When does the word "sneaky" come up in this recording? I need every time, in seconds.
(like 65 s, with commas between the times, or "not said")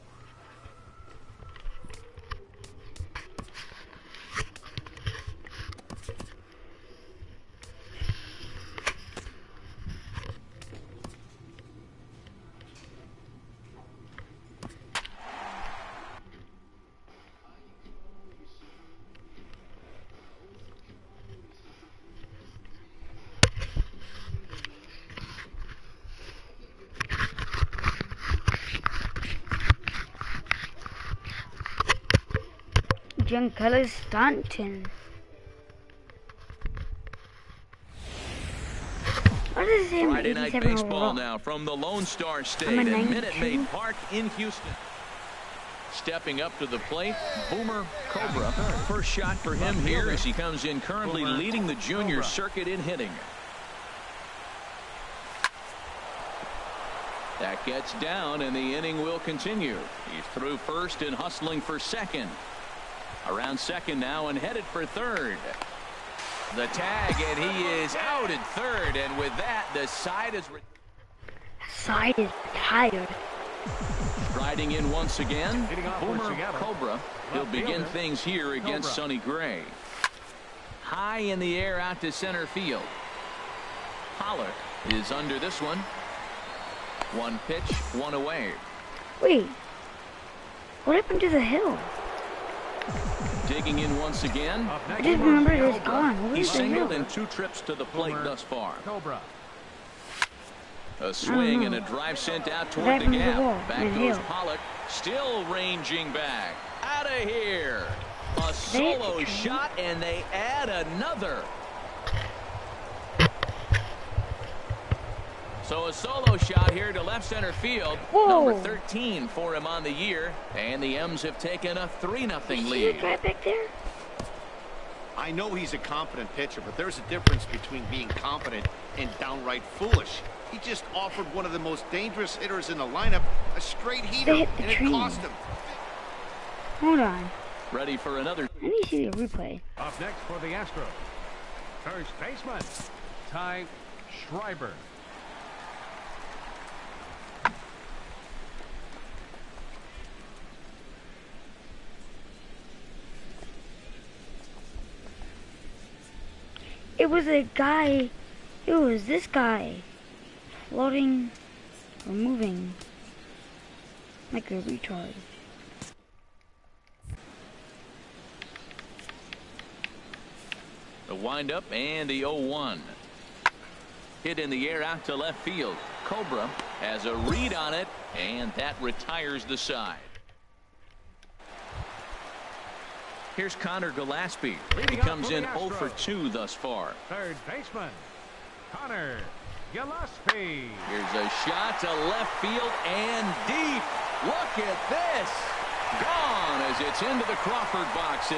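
not said.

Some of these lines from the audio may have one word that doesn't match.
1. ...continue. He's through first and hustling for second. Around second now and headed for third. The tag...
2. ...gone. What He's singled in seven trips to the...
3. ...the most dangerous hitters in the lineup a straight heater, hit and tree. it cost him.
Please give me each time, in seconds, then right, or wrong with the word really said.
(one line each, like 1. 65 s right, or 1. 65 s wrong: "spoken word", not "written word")
1. 59 s right
2. 95 s wrong: "two", not "seven"
3. 131 s right.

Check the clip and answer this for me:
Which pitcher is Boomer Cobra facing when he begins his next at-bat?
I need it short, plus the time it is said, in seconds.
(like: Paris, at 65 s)
Sonny Gray, at 78 s.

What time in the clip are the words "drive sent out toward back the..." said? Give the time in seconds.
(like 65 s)
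101 s.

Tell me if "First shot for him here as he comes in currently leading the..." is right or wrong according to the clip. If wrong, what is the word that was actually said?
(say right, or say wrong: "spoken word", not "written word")
right.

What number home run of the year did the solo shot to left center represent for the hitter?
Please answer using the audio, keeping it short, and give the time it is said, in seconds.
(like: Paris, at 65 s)
13, at 118 s.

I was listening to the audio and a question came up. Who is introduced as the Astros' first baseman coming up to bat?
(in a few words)
Ty Schreiber.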